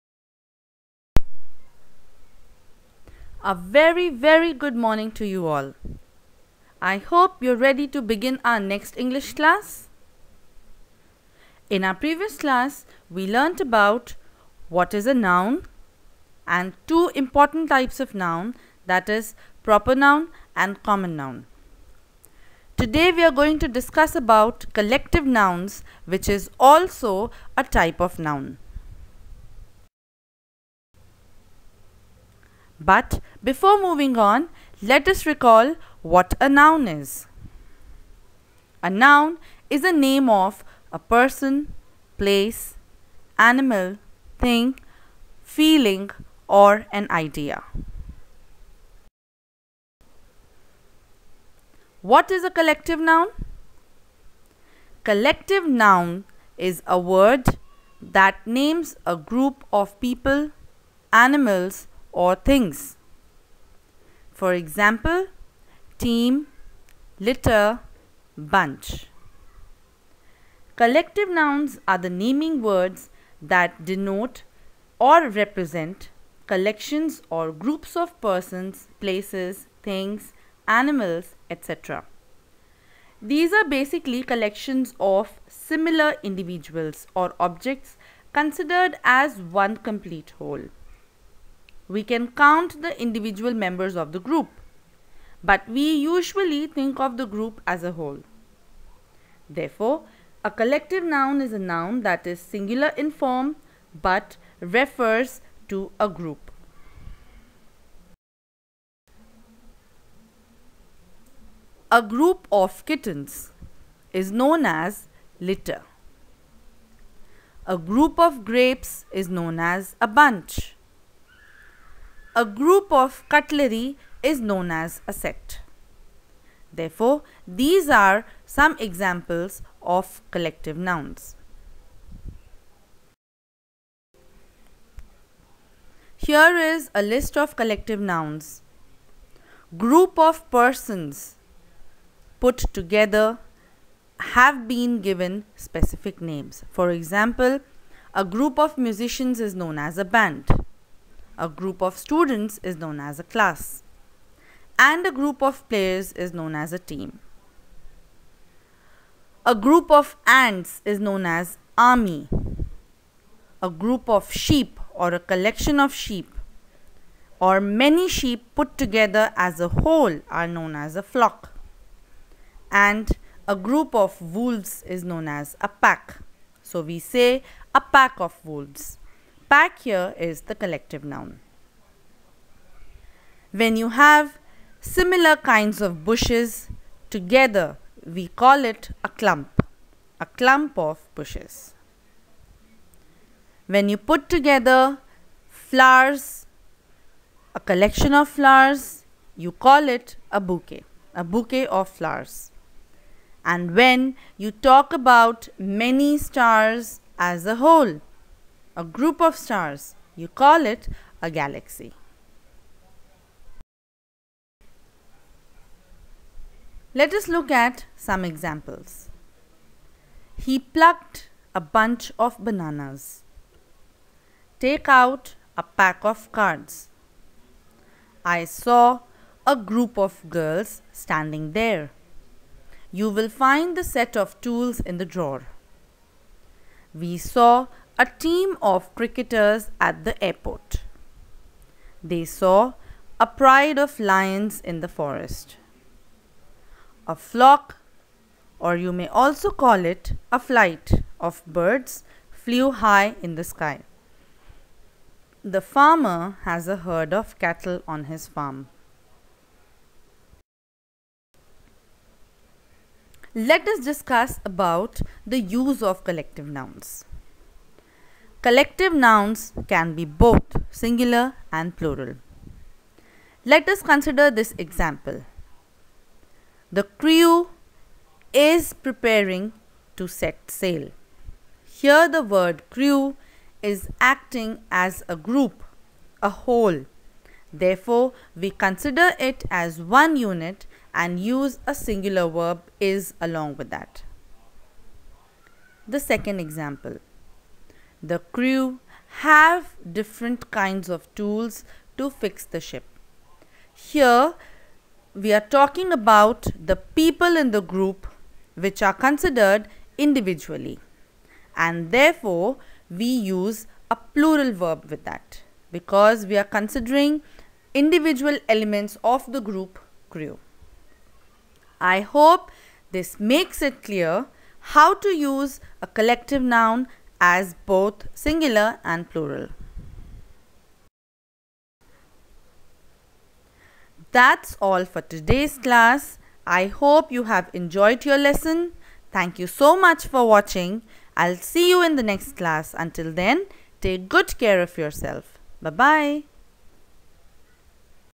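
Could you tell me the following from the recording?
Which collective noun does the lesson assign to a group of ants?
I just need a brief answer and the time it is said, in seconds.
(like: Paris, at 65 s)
army, at 161 s.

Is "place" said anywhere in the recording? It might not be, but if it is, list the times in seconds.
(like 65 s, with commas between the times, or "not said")
42 s, 78 s.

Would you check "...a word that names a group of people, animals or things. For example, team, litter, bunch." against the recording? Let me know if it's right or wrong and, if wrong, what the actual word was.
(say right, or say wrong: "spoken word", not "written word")
right.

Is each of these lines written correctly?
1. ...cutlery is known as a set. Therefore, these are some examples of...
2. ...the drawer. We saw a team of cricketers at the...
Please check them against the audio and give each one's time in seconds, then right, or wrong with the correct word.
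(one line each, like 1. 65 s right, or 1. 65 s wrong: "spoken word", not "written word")
1. 123 s right
2. 234 s right.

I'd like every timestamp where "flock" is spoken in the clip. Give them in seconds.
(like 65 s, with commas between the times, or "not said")
171 s, 247 s.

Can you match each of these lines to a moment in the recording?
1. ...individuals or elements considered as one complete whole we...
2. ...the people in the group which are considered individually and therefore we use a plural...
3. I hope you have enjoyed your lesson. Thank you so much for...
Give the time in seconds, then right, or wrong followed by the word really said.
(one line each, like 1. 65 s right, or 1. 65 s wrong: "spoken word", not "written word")
1. 86 s wrong: "objects", not "elements"
2. 306 s right
3. 336 s right.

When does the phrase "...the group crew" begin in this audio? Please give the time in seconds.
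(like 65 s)
319 s.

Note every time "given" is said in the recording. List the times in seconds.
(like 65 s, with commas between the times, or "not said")
145 s.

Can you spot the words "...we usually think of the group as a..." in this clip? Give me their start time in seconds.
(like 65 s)
95 s.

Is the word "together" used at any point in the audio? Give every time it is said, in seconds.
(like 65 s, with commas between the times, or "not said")
142 s, 168 s, 187 s, 194 s.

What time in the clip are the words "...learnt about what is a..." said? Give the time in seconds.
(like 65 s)
13 s.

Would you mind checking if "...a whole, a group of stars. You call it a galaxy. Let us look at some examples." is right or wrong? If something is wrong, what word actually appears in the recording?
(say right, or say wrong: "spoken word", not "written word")
right.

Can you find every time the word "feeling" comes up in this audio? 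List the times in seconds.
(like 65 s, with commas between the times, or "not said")
45 s.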